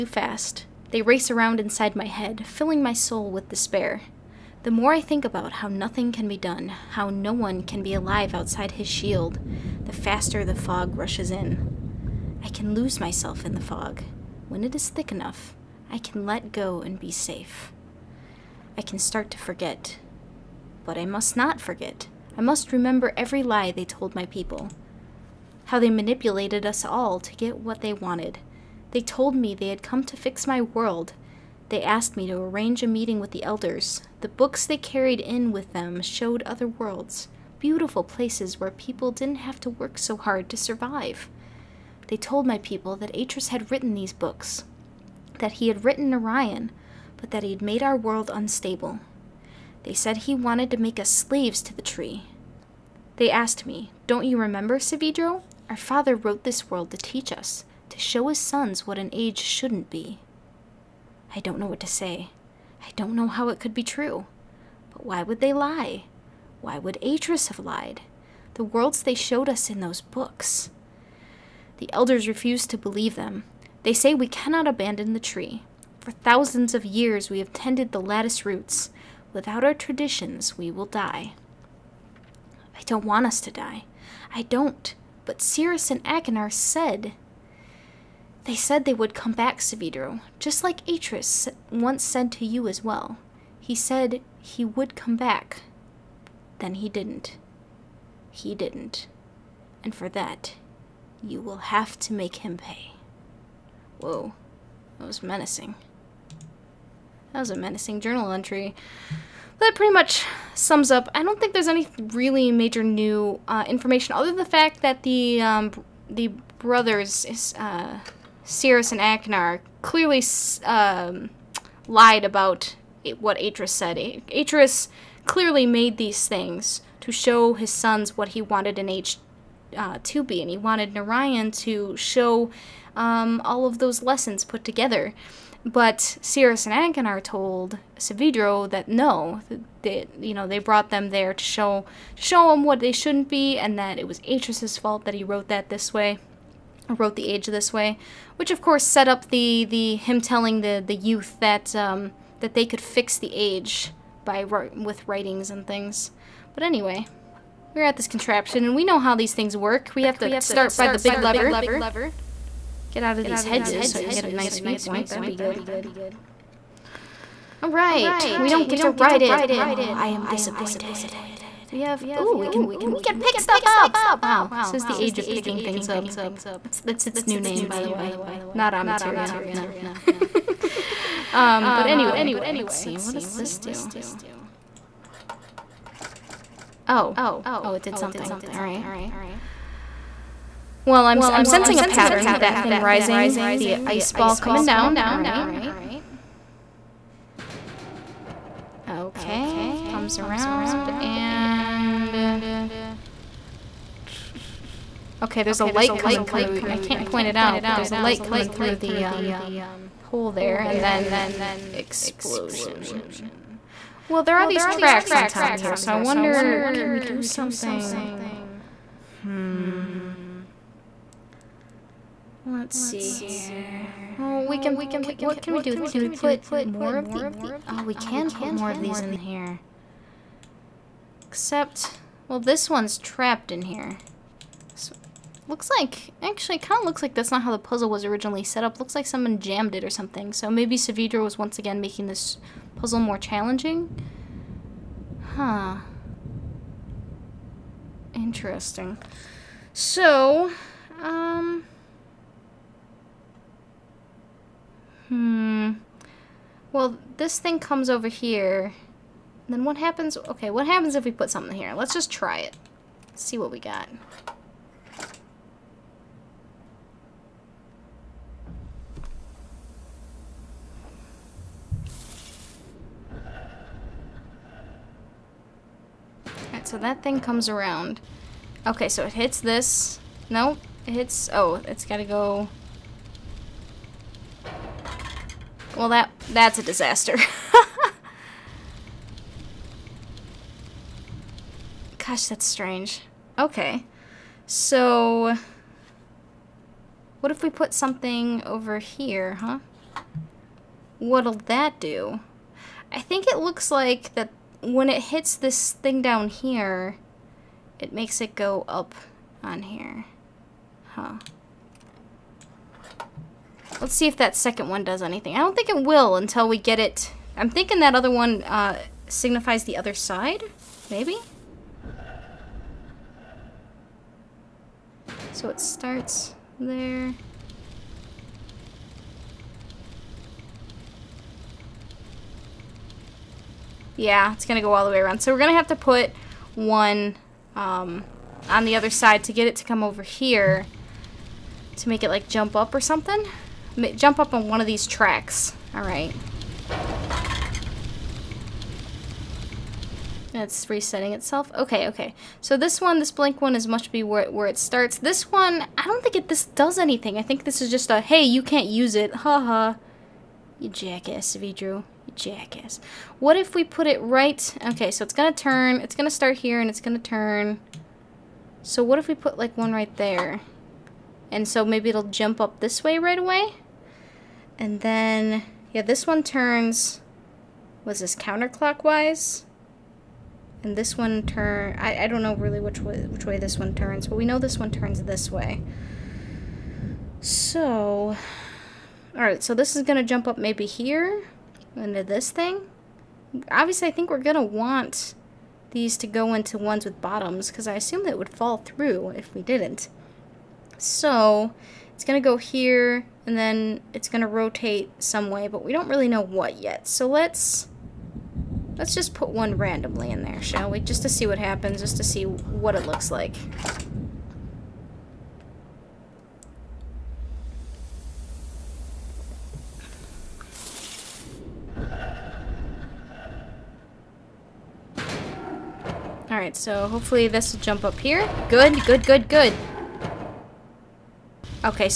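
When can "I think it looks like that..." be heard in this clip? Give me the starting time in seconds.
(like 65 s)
302 s.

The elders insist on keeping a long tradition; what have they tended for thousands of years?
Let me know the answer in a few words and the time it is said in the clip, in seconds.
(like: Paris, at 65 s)
the lattice roots, at 77 s.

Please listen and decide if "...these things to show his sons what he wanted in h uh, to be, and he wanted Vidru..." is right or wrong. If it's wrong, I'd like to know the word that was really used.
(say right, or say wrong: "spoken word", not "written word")
wrong: "Narayan", not "Vidru".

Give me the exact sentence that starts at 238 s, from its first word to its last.
Looks like someone jammed it or something.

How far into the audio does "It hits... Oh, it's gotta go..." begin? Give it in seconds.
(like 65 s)
280 s.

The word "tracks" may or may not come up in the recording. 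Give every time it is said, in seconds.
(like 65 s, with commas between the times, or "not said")
214 s, 344 s.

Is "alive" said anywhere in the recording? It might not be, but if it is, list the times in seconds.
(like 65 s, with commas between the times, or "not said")
7 s.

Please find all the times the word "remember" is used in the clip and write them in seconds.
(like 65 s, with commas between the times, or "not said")
22 s, 54 s.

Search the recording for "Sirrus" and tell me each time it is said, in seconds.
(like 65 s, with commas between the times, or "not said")
85 s, 118 s, 136 s.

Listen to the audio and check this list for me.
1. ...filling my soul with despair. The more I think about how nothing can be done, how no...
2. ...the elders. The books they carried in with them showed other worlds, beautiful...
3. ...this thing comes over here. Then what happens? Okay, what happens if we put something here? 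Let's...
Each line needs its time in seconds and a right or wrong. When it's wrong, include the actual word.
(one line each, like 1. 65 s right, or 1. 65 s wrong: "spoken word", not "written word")
1. 2 s right
2. 33 s right
3. 257 s right.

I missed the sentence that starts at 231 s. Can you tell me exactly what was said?
Except, well, this one's trapped in here.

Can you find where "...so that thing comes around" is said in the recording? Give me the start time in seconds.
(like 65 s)
276 s.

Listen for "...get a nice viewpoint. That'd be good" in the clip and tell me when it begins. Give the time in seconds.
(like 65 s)
164 s.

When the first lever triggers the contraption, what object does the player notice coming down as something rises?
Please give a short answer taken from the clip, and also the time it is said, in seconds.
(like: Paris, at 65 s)
the ice ball, at 193 s.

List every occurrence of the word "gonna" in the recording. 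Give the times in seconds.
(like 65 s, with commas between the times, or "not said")
389 s, 394 s.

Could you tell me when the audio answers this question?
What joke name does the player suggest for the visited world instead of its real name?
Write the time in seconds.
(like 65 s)
174 s.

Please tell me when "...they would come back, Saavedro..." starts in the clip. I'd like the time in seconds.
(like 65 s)
88 s.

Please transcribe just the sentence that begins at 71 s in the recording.
The elders refuse to believe them.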